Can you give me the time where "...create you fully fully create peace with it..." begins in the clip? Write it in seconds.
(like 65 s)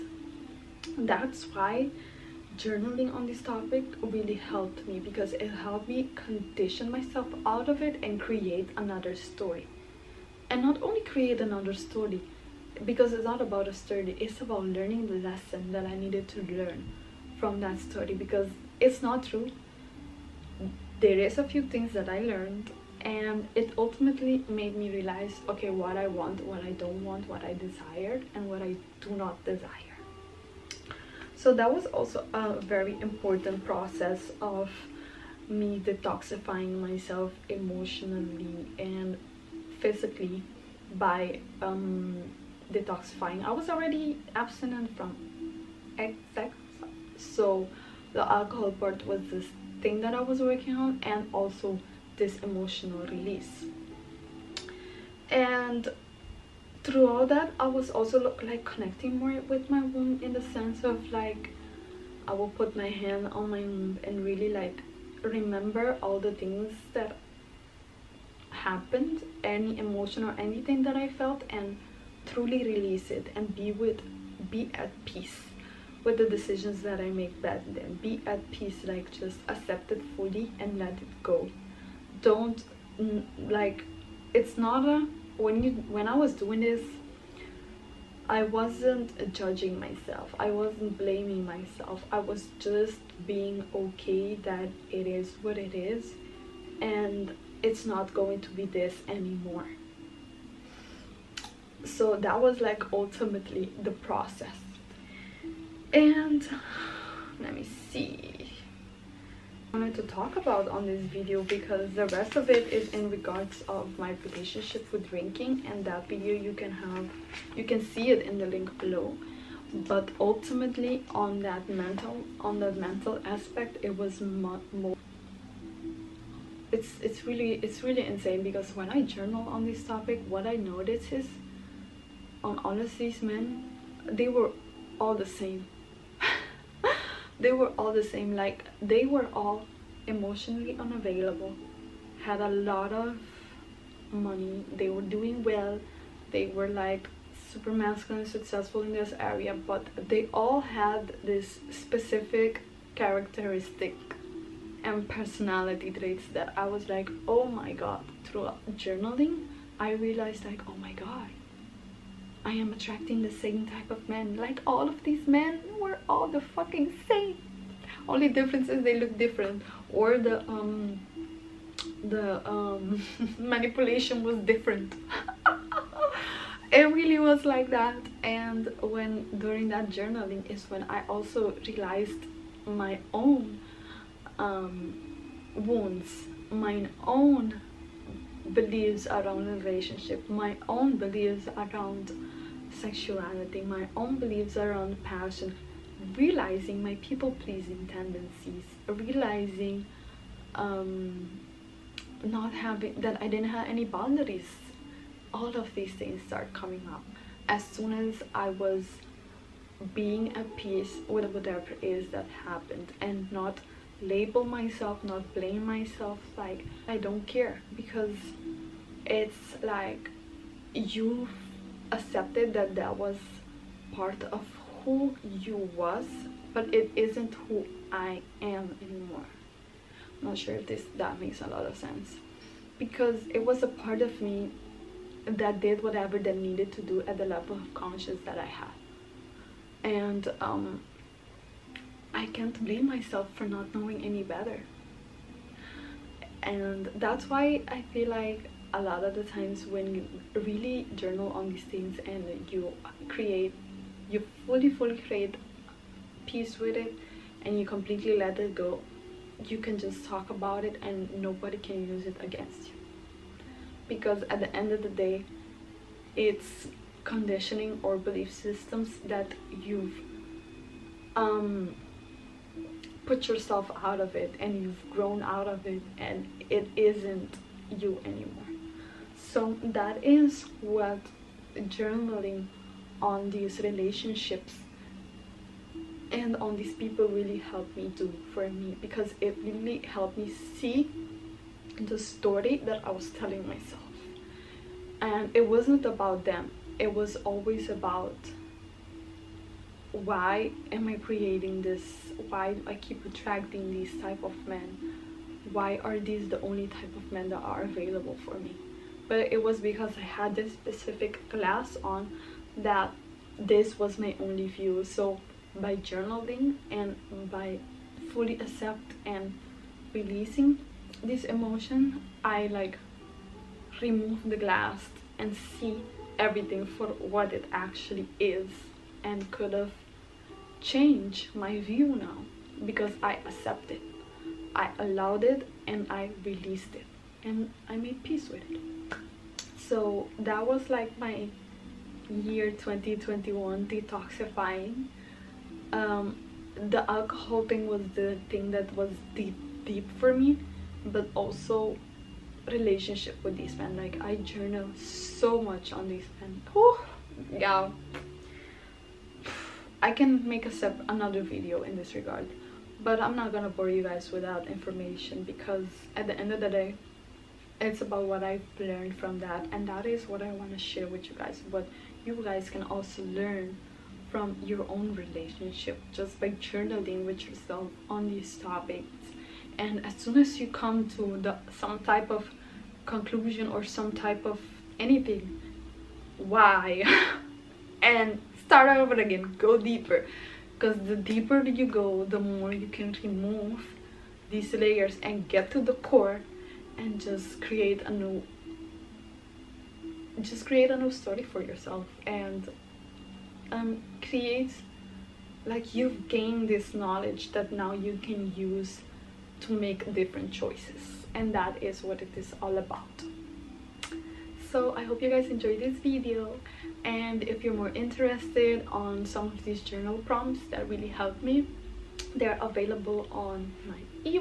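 253 s.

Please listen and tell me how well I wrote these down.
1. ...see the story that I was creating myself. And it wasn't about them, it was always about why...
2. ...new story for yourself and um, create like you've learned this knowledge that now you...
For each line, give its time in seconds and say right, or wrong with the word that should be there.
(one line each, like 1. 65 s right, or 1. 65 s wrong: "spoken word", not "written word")
1. 290 s wrong: "telling", not "creating"
2. 400 s wrong: "gained", not "learned".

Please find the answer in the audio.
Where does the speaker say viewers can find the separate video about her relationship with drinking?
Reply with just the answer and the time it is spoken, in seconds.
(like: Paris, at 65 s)
link below, at 118 s.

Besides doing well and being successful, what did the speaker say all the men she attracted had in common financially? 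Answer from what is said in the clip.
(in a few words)
a lot of money.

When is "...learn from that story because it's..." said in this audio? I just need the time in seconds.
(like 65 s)
16 s.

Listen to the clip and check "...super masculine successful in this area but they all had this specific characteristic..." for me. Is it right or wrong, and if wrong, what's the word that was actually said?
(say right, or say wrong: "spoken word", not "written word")
right.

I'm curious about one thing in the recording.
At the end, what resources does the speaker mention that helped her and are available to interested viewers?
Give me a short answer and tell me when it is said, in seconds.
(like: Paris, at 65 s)
journal prompts, at 419 s.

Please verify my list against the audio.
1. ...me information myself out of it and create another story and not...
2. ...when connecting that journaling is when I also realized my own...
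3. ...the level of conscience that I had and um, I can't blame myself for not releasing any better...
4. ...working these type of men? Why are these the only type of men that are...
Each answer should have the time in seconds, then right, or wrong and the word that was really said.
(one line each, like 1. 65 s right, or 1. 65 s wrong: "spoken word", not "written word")
1. 5 s wrong: "condition", not "information"
2. 178 s wrong: "during", not "connecting"
3. 237 s wrong: "knowing", not "releasing"
4. 303 s wrong: "attracting", not "working".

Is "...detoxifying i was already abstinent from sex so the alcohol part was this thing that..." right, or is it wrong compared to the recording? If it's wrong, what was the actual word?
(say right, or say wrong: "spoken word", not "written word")
right.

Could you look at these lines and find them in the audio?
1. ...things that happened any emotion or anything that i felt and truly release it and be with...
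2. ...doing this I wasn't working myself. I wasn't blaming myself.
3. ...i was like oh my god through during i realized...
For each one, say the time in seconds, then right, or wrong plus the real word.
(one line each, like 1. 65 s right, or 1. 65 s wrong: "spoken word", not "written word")
1. 66 s right
2. 86 s wrong: "judging", not "working"
3. 156 s wrong: "journaling", not "during".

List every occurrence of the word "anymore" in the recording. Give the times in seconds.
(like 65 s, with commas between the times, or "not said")
99 s, 228 s, 278 s.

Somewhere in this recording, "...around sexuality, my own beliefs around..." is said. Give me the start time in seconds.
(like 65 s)
191 s.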